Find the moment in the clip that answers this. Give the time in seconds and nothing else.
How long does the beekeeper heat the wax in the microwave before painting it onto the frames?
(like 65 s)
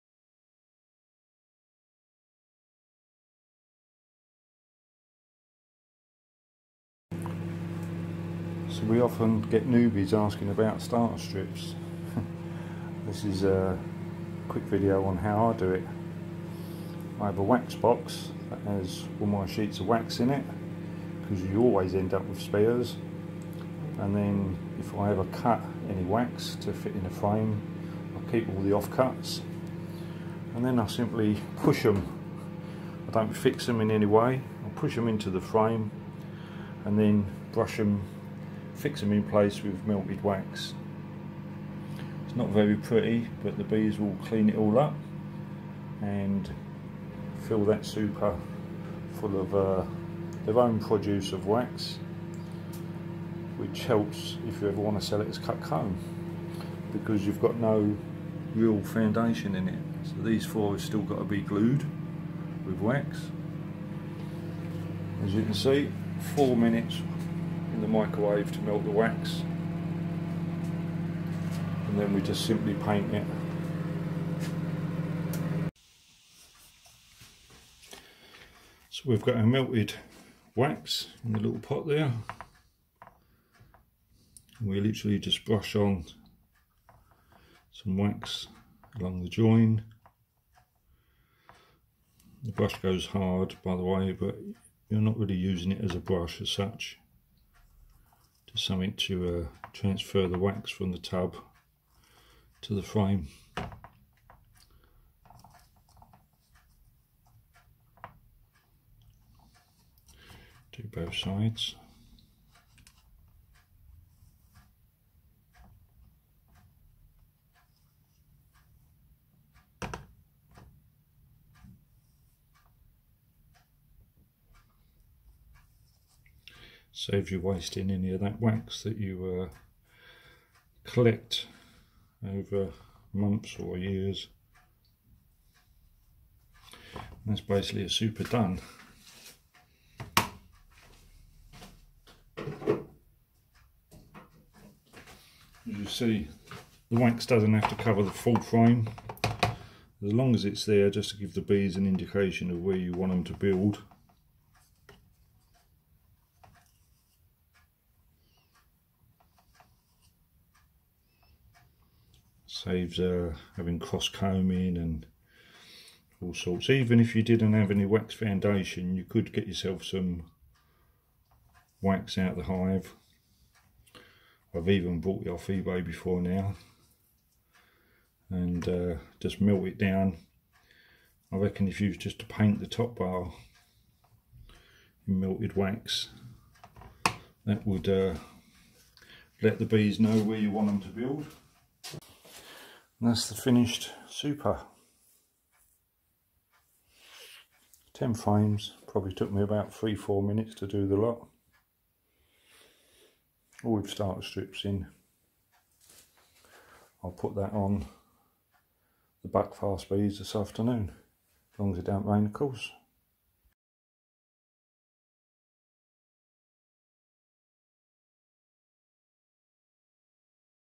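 66 s.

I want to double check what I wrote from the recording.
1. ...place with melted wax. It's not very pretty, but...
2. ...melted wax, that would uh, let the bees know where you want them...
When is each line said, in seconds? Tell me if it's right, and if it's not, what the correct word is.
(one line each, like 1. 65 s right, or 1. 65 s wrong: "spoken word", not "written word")
1. 39 s right
2. 185 s right.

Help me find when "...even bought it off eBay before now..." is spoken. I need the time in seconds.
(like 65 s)
174 s.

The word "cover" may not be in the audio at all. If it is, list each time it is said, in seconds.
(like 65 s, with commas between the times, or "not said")
147 s.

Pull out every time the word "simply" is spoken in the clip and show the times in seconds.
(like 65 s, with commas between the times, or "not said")
30 s, 72 s.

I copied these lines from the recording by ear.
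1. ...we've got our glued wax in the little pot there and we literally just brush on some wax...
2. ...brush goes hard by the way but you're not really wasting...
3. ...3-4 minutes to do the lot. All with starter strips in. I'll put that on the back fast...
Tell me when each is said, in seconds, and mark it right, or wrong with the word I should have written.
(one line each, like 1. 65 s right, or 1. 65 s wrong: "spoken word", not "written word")
1. 79 s wrong: "melted", not "glued"
2. 92 s wrong: "using", not "wasting"
3. 199 s right.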